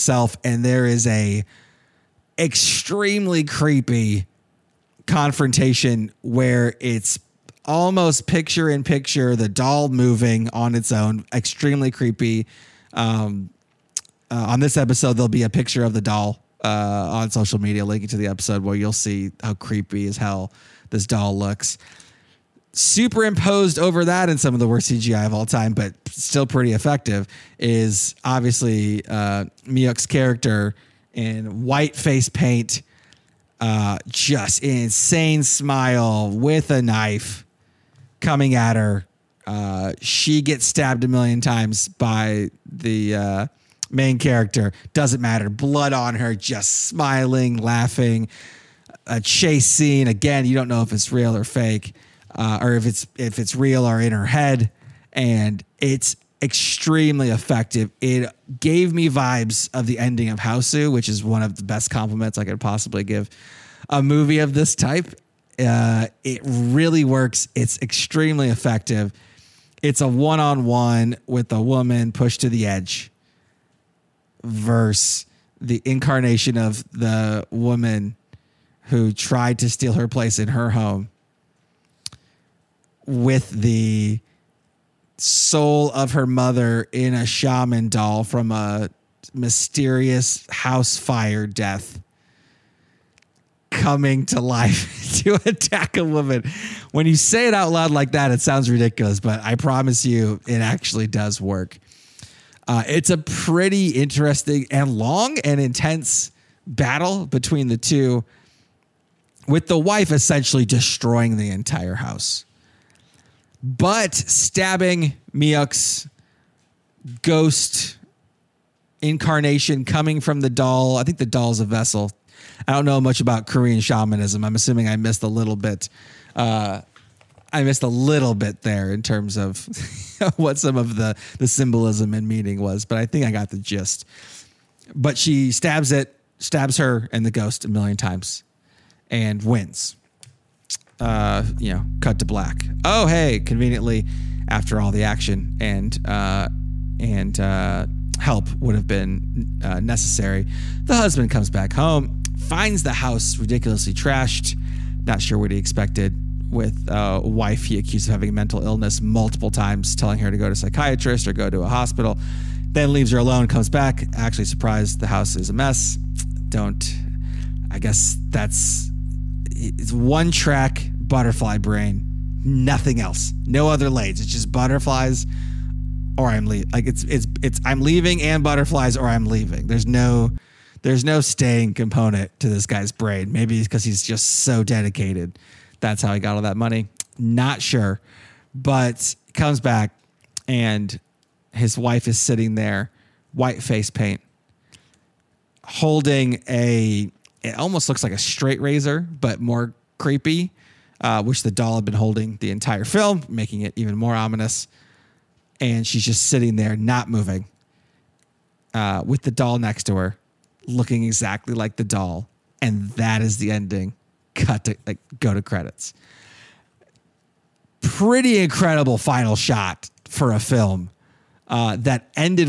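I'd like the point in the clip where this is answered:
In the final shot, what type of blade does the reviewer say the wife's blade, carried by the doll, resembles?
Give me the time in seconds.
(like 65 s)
198 s.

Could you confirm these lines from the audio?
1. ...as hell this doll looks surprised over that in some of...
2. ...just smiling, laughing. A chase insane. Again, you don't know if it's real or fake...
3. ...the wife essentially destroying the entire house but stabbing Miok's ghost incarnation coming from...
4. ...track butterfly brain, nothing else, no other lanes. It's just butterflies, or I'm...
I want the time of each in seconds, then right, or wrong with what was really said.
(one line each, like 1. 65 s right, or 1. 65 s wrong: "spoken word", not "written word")
1. 20 s wrong: "superimposed", not "surprised"
2. 46 s wrong: "scene", not "insane"
3. 109 s right
4. 170 s right.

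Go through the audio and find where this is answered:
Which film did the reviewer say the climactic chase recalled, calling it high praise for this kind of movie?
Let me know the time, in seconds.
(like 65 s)
60 s.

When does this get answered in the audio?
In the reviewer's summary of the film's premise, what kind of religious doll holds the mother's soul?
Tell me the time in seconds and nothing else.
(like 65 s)
87 s.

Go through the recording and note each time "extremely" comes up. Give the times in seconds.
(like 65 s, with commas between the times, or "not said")
2 s, 11 s, 56 s, 67 s.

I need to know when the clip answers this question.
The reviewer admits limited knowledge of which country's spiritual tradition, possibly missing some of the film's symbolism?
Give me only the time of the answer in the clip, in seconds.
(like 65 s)
123 s.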